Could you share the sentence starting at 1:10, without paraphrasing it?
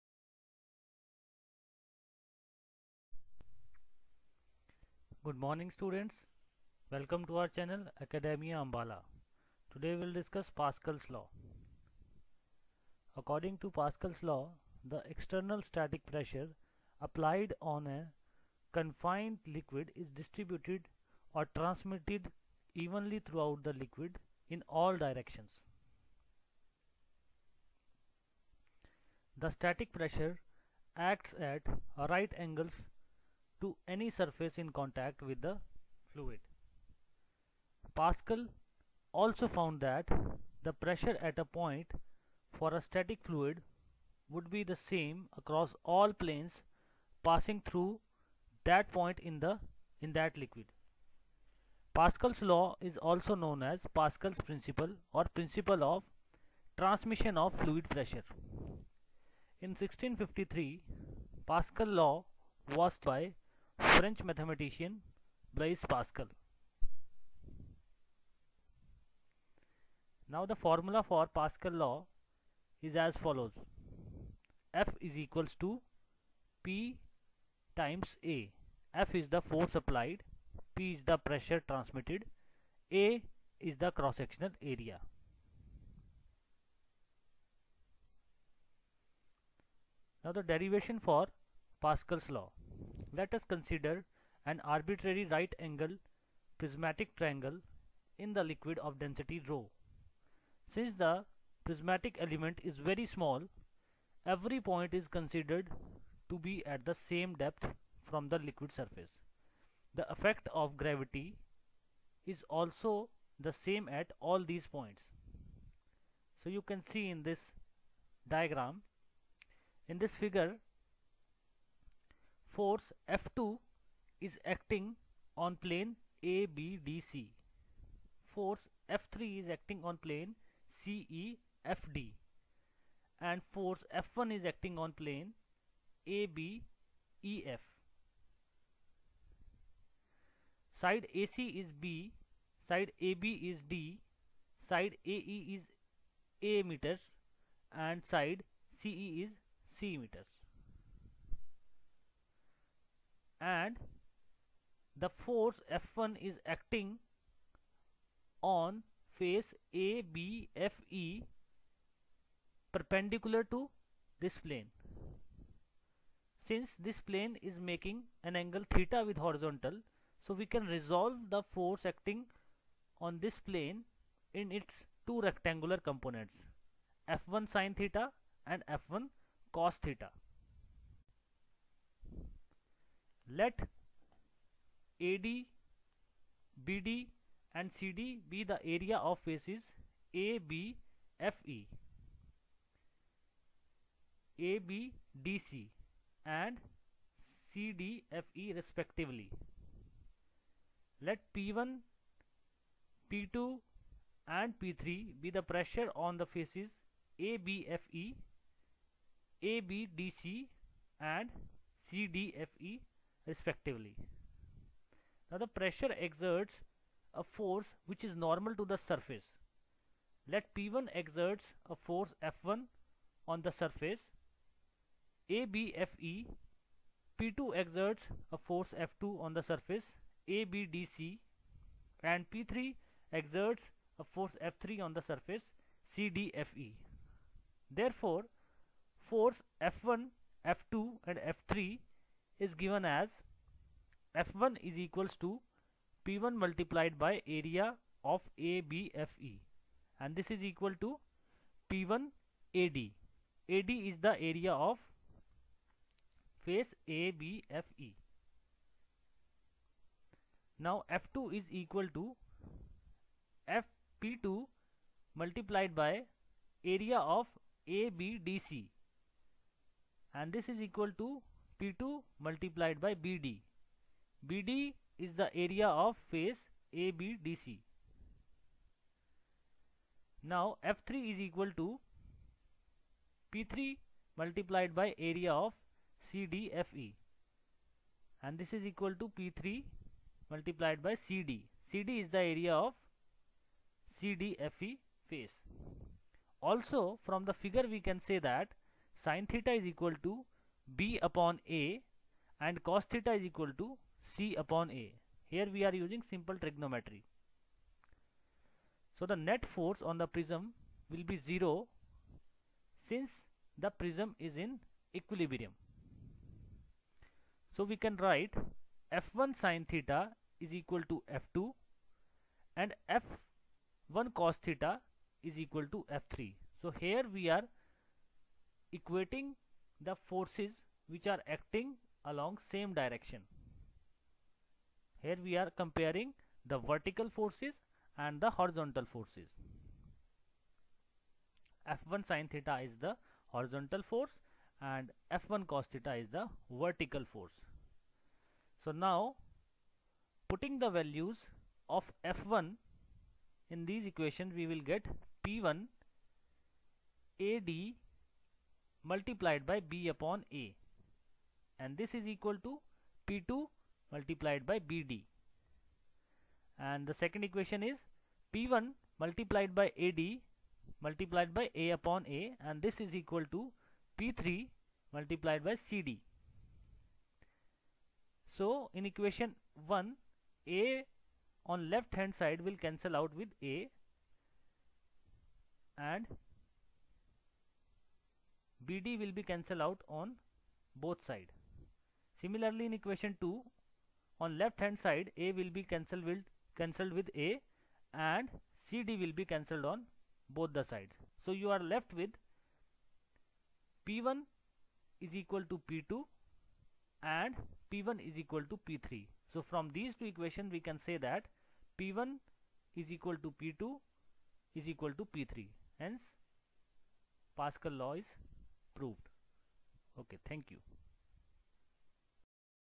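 Now the formula for Pascal law is as follows.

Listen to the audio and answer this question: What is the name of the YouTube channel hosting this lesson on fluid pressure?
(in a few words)
Academia Ambala.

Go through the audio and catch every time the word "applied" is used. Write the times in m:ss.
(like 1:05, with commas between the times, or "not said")
0:17, 1:19.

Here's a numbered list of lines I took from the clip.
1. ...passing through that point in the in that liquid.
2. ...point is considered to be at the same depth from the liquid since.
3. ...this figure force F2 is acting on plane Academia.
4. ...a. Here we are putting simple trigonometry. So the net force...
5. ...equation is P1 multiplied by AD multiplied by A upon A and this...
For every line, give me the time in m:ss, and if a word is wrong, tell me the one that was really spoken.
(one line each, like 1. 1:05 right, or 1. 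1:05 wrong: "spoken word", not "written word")
1. 0:47 right
2. 1:44 wrong: "surface", not "since"
3. 1:59 wrong: "ABDC", not "Academia"
4. 5:04 wrong: "using", not "putting"
5. 6:07 right.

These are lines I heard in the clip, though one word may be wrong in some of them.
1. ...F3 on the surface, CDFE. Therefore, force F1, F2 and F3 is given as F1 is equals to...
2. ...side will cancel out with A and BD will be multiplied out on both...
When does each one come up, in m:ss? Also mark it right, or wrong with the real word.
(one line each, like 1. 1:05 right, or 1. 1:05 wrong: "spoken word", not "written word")
1. 3:54 right
2. 6:22 wrong: "cancelled", not "multiplied".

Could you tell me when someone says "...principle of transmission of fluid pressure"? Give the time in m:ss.
0:55.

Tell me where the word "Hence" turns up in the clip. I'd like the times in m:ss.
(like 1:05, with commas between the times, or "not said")
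6:55.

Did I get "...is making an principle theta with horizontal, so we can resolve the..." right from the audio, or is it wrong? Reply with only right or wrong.
wrong.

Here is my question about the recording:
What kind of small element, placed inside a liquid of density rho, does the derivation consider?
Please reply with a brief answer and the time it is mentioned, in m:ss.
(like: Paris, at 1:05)
right angle prismatic triangle, at 1:35.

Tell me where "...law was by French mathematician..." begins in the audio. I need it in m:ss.
1:02.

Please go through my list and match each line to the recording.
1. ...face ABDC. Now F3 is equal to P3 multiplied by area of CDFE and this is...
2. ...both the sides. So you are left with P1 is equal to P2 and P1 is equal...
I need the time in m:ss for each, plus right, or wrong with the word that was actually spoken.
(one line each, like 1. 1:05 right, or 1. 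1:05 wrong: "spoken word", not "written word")
1. 4:36 right
2. 6:40 right.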